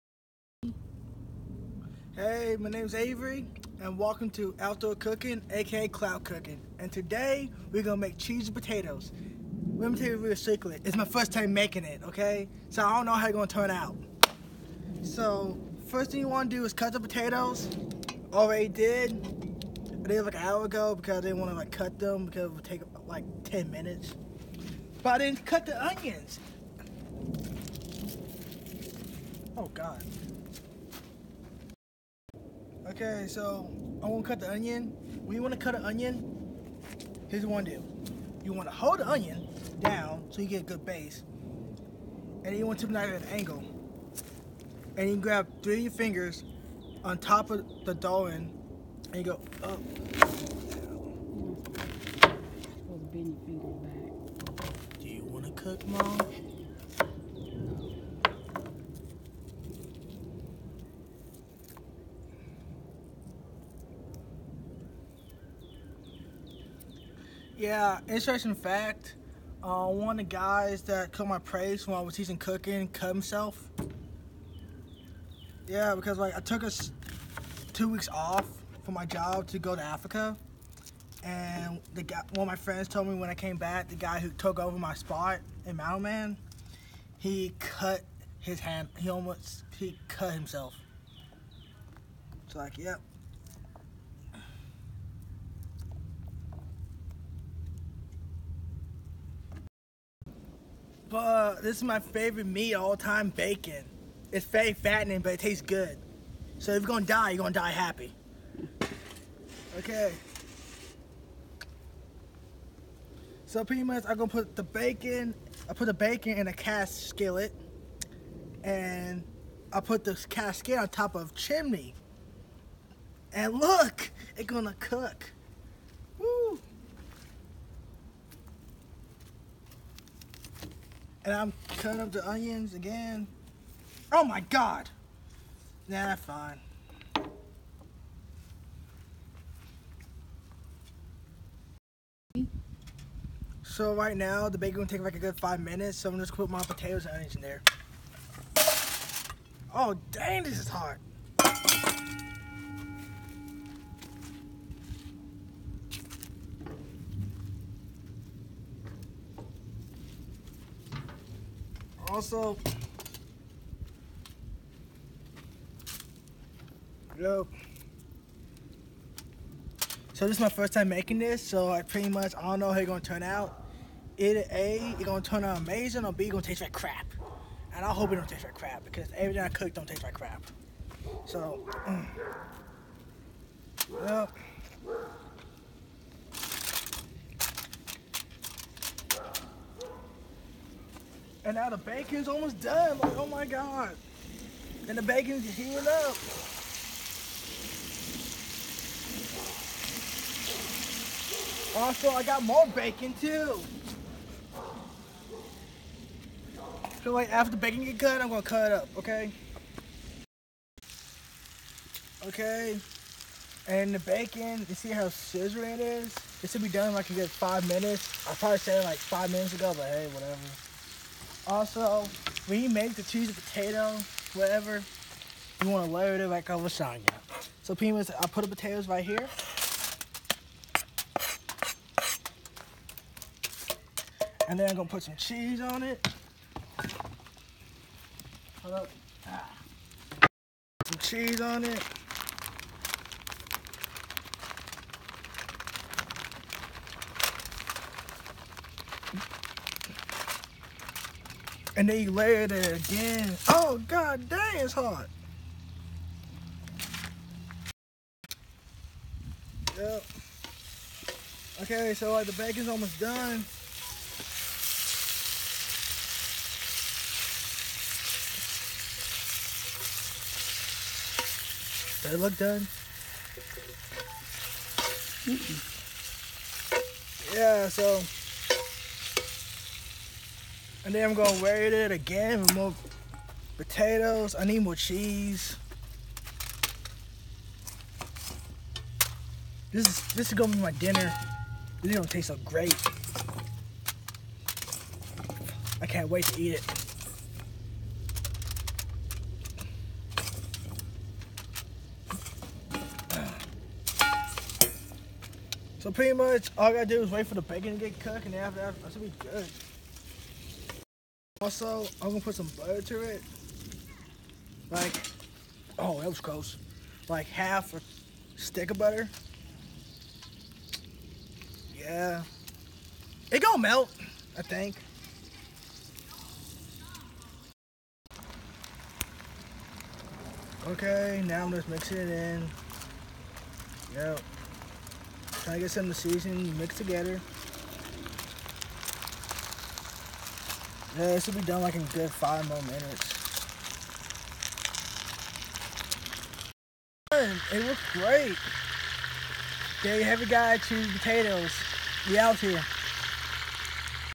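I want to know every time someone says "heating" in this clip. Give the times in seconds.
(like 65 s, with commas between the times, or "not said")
195 s.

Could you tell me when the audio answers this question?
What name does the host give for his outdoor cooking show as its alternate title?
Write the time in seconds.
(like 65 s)
5 s.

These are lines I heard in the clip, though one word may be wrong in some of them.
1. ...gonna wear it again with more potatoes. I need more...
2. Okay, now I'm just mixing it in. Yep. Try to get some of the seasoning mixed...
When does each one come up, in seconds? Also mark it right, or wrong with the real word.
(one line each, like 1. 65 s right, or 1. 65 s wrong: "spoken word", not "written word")
1. 281 s right
2. 330 s right.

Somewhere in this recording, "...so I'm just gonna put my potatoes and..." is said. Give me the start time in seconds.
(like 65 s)
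145 s.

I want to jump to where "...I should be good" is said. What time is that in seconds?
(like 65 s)
308 s.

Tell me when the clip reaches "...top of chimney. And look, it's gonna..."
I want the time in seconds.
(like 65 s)
120 s.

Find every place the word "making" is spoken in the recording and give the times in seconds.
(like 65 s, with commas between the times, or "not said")
11 s, 170 s.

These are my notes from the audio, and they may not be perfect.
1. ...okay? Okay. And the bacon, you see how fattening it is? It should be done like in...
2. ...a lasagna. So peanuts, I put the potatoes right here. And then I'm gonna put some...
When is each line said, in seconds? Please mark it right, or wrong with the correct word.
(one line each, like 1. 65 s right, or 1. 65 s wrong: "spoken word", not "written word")
1. 208 s wrong: "scissoring", not "fattening"
2. 226 s right.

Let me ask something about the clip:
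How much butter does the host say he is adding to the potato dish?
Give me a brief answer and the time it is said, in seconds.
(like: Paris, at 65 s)
half a stick, at 317 s.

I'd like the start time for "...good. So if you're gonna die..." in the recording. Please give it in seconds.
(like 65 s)
105 s.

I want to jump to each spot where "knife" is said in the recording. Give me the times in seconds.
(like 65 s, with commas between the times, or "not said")
42 s.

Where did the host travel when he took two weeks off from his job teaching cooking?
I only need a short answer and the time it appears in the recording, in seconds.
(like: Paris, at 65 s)
Africa, at 79 s.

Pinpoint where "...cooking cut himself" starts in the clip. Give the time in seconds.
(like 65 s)
72 s.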